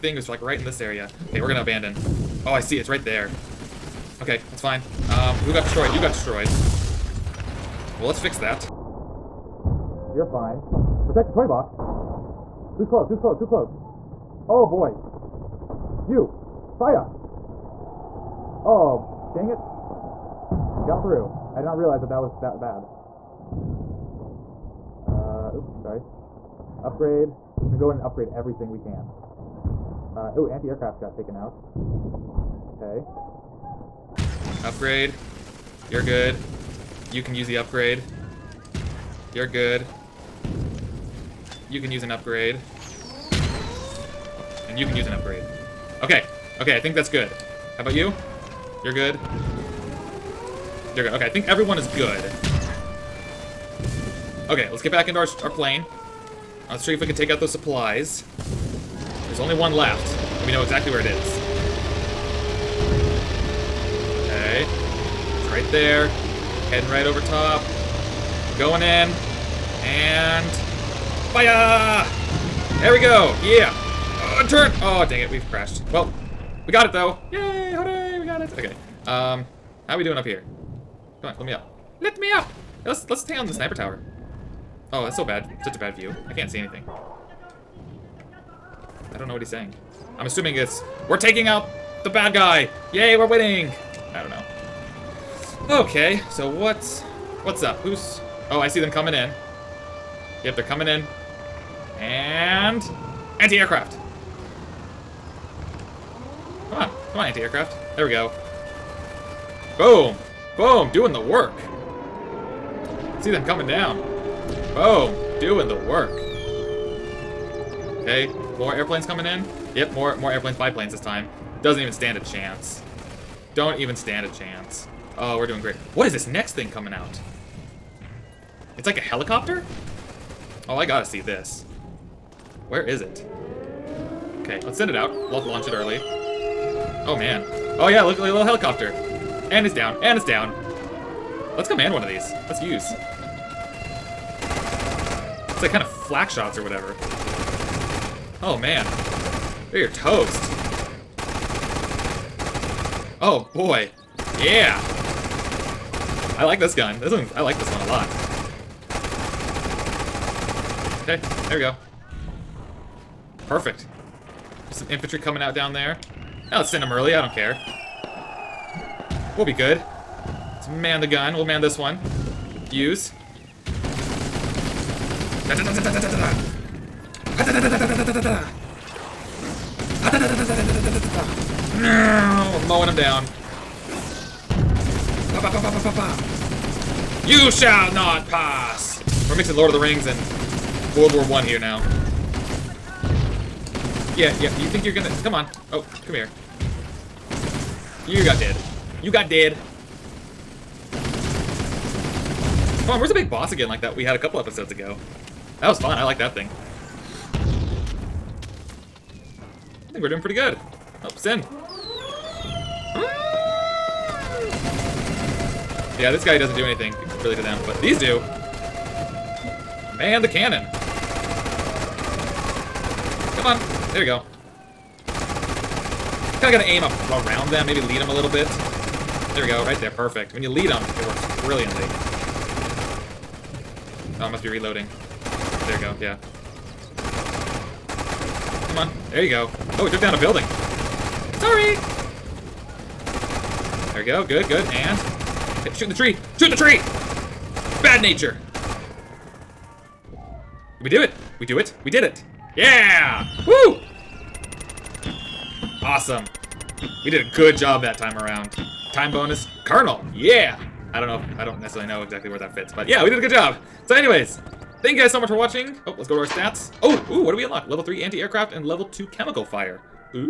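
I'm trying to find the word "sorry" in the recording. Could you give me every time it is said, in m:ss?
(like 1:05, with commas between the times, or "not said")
0:25, 4:01.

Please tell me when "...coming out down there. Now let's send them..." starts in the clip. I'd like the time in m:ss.
2:45.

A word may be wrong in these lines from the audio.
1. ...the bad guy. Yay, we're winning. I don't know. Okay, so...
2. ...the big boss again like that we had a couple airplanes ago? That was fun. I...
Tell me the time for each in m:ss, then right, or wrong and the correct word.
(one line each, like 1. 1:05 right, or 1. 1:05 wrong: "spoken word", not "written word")
1. 1:32 right
2. 3:23 wrong: "episodes", not "airplanes".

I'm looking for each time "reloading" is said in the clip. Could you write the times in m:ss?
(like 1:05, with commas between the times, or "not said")
3:54.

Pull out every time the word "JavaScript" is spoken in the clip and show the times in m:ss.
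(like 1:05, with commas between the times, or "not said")
not said.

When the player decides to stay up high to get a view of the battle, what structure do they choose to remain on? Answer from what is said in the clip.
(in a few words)
Sniper tower.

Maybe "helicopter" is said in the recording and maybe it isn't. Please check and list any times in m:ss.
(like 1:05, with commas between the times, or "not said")
2:09, 2:18.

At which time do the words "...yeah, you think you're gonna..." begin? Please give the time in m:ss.
3:14.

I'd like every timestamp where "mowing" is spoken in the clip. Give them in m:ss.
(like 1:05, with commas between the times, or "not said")
3:02.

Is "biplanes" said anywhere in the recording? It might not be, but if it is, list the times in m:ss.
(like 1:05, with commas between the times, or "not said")
2:00.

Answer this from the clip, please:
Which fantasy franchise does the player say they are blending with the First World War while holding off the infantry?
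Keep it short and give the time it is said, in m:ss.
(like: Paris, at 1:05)
Lord of the Rings, at 3:09.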